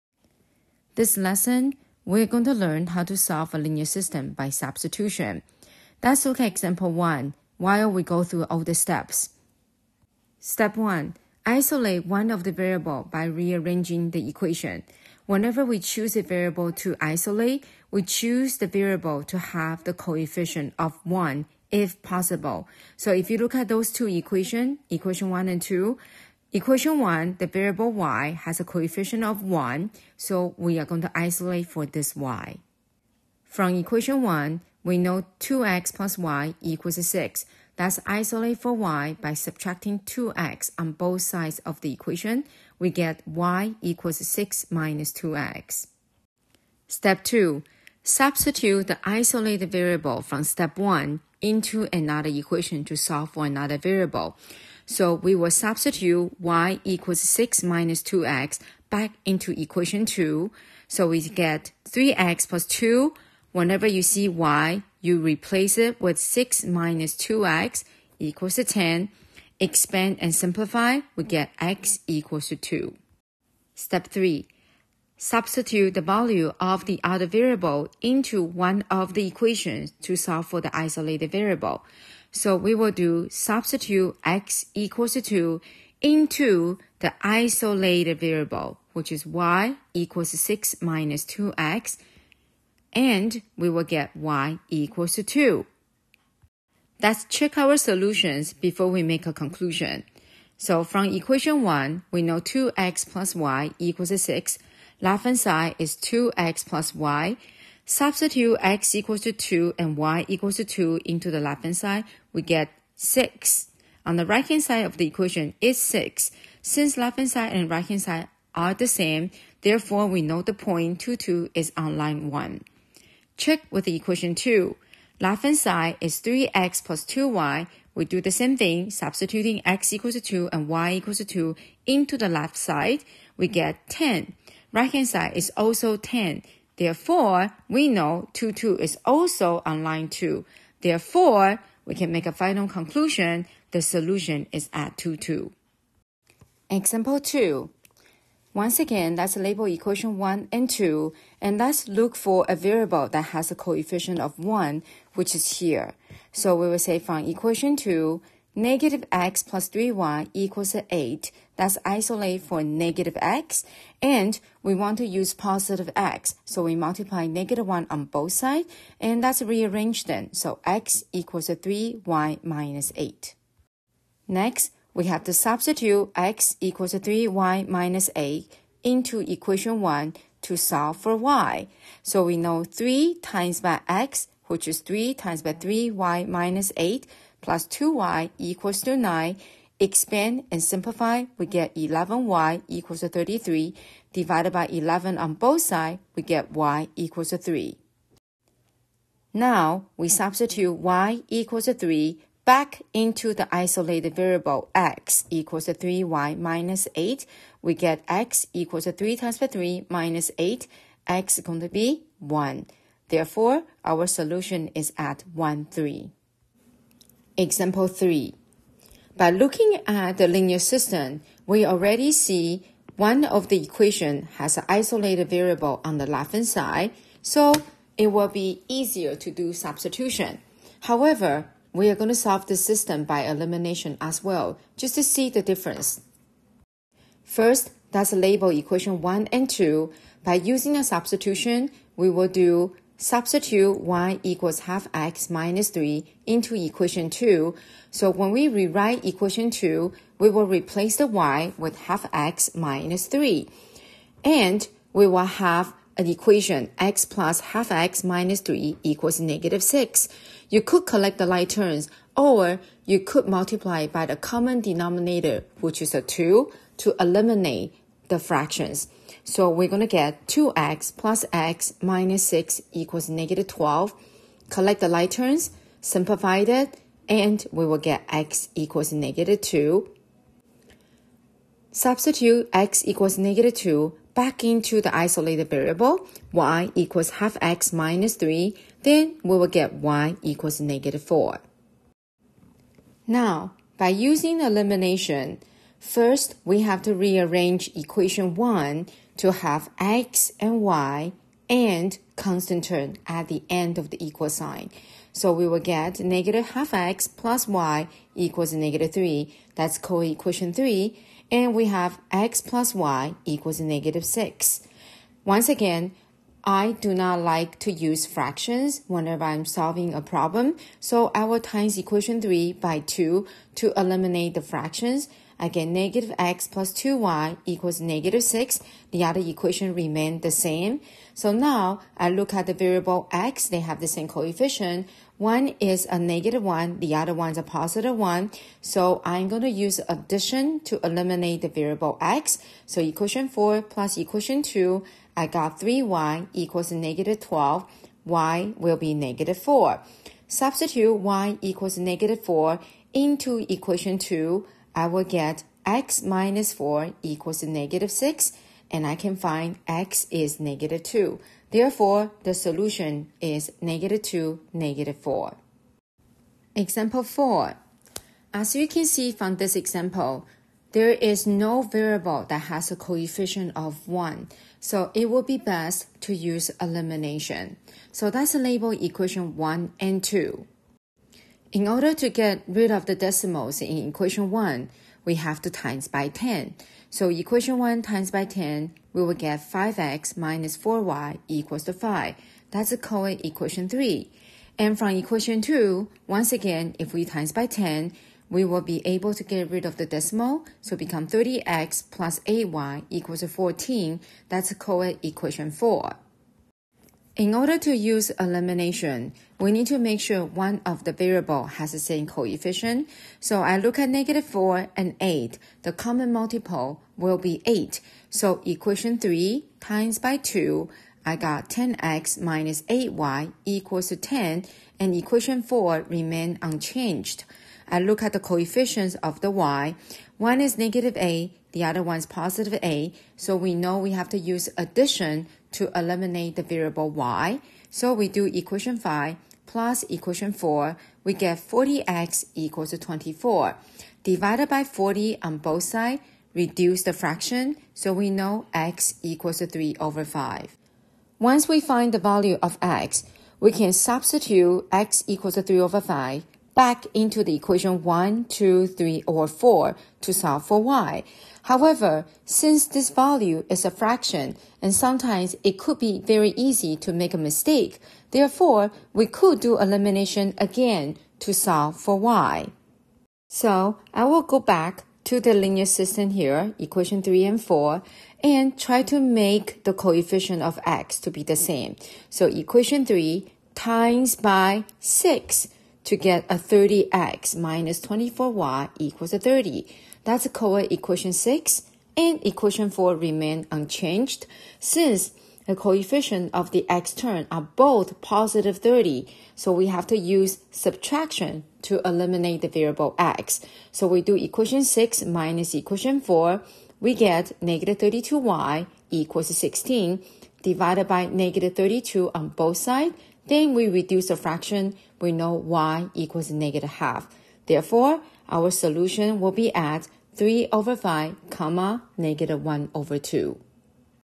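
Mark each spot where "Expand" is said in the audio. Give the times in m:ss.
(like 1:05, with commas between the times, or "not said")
1:09, 3:09.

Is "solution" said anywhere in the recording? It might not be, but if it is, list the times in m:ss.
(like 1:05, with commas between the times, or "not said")
1:37, 2:23, 3:34, 6:02, 8:38.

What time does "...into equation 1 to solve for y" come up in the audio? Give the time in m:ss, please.
2:58.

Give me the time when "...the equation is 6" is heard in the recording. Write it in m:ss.
1:54.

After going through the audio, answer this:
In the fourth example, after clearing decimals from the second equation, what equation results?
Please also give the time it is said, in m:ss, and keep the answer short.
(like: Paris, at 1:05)
30x + 8y = 14, at 6:41.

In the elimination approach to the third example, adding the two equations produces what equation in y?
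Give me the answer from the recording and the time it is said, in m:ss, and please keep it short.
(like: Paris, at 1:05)
3y = -12, at 5:45.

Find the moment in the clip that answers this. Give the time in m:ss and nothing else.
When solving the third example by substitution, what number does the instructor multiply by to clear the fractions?
4:25.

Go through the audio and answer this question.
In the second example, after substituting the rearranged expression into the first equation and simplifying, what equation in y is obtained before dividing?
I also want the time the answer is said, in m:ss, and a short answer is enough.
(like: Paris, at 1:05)
11y = 33, at 3:11.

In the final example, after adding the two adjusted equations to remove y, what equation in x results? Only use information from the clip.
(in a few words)
40x = 24.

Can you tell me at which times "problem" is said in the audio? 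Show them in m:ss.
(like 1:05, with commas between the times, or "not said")
5:20.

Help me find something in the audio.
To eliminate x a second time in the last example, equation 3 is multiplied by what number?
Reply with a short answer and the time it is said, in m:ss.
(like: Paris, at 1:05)
6, at 8:03.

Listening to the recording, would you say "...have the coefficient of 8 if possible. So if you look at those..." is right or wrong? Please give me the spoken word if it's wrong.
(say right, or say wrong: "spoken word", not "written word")
wrong: "1", not "8".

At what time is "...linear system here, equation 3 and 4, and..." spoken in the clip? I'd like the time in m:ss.
7:55.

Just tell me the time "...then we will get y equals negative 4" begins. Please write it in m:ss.
4:48.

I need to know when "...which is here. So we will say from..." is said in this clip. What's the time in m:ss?
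2:35.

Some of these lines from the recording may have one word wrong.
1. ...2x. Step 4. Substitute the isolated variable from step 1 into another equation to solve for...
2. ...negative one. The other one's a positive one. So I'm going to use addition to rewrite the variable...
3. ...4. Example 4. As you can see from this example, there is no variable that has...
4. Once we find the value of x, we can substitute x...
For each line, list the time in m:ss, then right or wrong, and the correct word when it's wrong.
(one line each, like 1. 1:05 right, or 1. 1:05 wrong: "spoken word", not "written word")
1. 0:45 wrong: "2", not "4"
2. 5:35 wrong: "eliminate", not "rewrite"
3. 6:04 right
4. 7:31 right.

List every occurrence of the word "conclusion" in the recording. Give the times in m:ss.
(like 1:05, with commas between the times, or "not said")
1:39, 2:22.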